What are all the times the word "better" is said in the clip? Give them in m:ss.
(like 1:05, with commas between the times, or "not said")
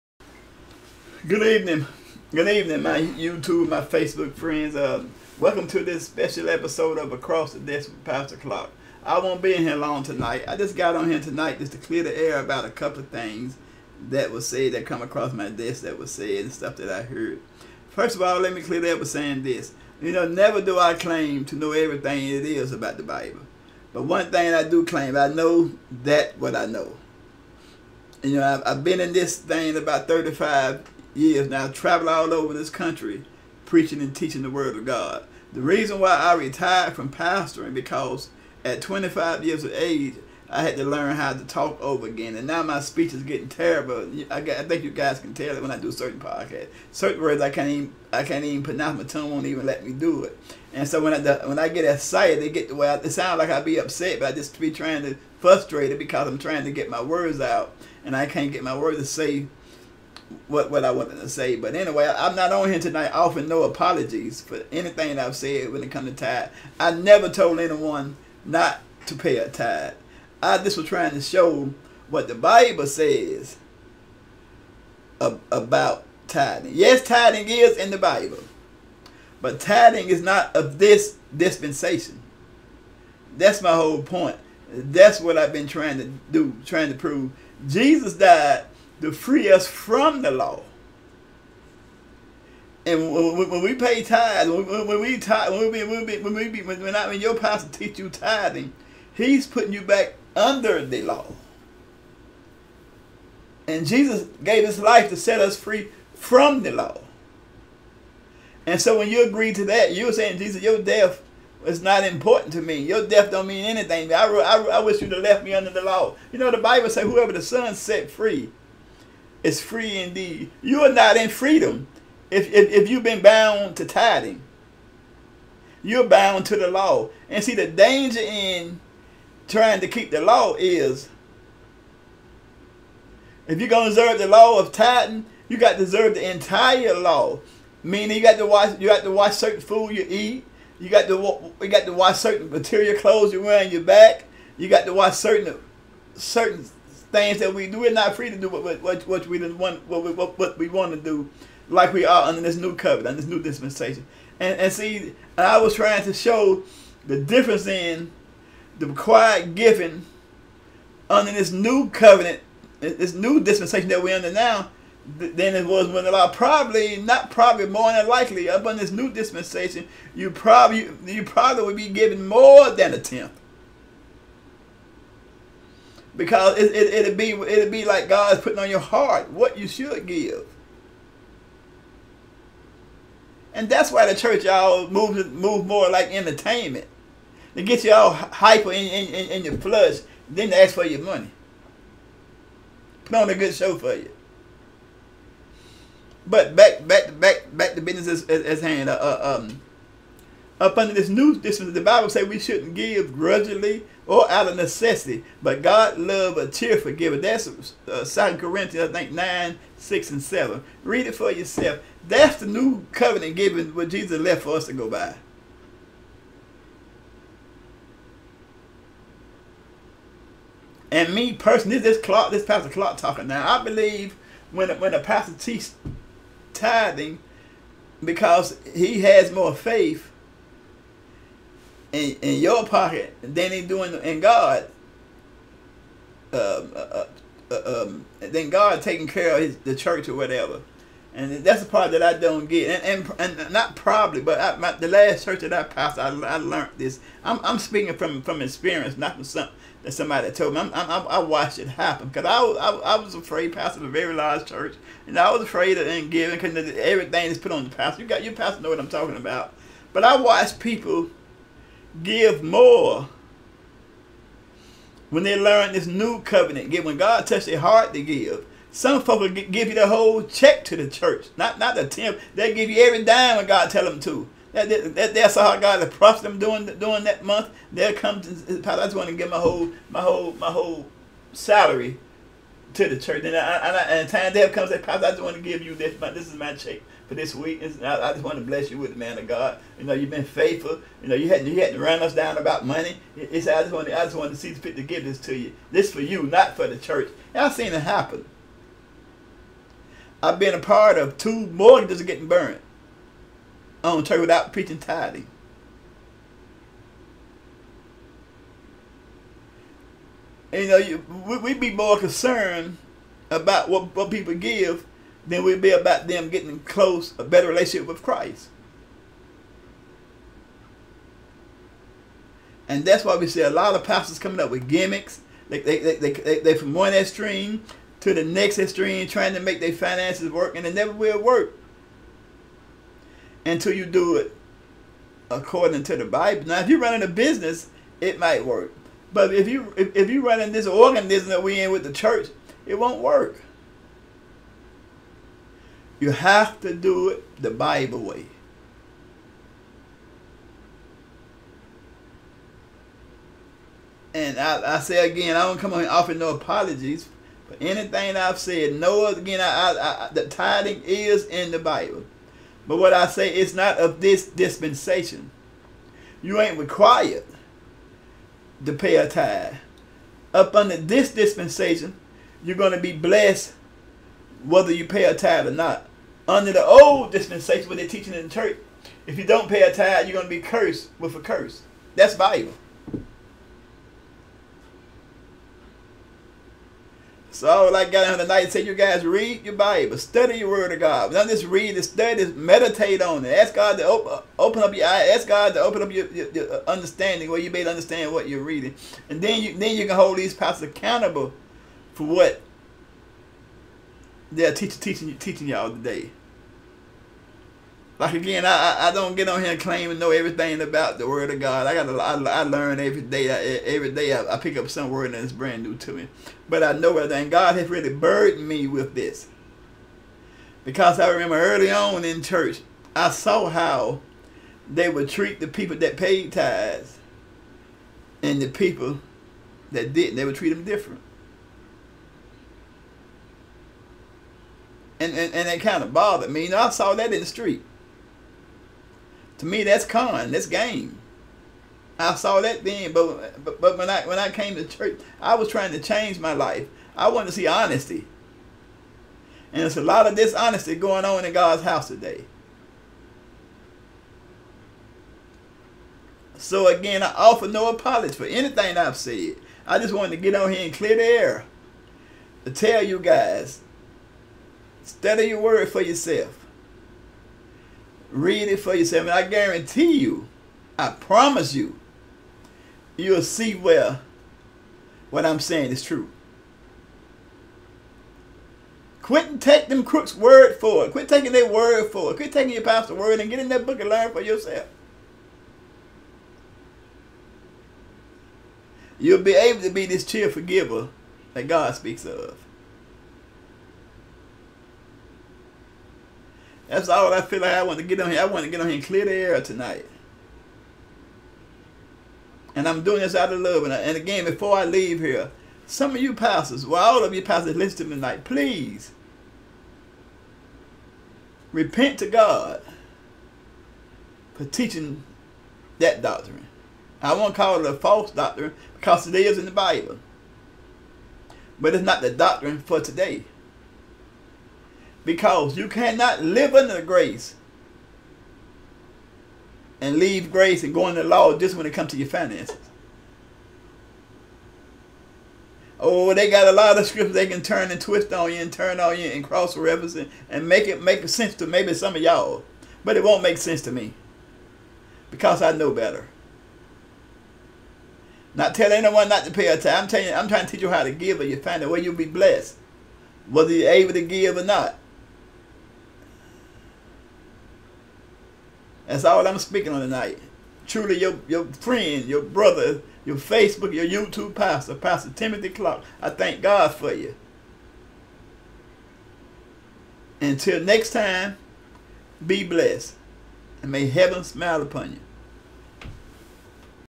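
5:17, 9:05.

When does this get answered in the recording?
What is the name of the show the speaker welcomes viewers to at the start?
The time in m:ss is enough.
0:07.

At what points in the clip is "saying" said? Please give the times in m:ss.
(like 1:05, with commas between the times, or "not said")
0:19, 1:50, 7:55.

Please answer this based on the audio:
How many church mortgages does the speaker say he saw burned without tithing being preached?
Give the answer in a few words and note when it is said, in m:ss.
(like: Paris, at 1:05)
2, at 5:01.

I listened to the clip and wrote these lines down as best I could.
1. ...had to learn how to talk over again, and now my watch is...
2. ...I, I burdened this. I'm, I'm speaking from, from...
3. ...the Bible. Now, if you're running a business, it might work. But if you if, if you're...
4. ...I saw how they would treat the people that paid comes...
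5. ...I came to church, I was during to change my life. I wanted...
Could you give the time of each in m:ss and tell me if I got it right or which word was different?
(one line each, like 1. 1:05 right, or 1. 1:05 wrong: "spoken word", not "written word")
1. 0:40 wrong: "speech", not "watch"
2. 4:05 wrong: "learned", not "burdened"
3. 5:35 right
4. 7:02 wrong: "tithes", not "comes"
5. 7:24 wrong: "trying", not "during".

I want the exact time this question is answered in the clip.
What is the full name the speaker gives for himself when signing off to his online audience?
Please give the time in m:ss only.
9:24.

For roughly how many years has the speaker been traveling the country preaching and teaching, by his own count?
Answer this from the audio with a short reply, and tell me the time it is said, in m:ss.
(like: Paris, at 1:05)
35, at 0:30.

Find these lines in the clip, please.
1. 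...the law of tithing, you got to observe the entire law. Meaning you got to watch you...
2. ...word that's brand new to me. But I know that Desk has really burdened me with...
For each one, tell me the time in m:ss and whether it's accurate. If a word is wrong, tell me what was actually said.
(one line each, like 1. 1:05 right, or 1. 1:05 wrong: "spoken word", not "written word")
1. 2:14 right
2. 6:54 wrong: "God", not "Desk".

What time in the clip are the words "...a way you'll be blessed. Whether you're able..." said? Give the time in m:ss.
9:11.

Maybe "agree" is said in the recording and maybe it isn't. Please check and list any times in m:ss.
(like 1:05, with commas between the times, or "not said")
1:49.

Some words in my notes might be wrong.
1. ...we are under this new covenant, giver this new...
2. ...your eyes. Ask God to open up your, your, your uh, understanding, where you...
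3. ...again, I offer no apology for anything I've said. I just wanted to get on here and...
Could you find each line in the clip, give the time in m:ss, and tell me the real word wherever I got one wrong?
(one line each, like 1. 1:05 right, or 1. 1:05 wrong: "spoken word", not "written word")
1. 2:31 wrong: "under", not "giver"
2. 6:34 right
3. 7:36 right.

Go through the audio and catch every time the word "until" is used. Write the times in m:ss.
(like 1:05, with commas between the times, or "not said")
5:33, 9:30.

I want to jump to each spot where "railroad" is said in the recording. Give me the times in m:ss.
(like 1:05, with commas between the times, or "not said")
not said.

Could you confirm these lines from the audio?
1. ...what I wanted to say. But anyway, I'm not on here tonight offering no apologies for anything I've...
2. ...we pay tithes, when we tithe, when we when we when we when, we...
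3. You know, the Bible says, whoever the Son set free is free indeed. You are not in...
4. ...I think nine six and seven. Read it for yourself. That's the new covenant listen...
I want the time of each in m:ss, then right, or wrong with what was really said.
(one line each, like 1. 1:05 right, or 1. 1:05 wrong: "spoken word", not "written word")
1. 1:00 right
2. 1:33 right
3. 1:56 right
4. 3:28 wrong: "given", not "listen".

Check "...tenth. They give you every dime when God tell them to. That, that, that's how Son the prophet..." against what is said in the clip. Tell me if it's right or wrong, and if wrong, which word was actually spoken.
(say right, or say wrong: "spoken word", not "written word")
wrong: "God", not "Son".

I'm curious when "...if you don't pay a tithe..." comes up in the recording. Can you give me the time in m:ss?
6:19.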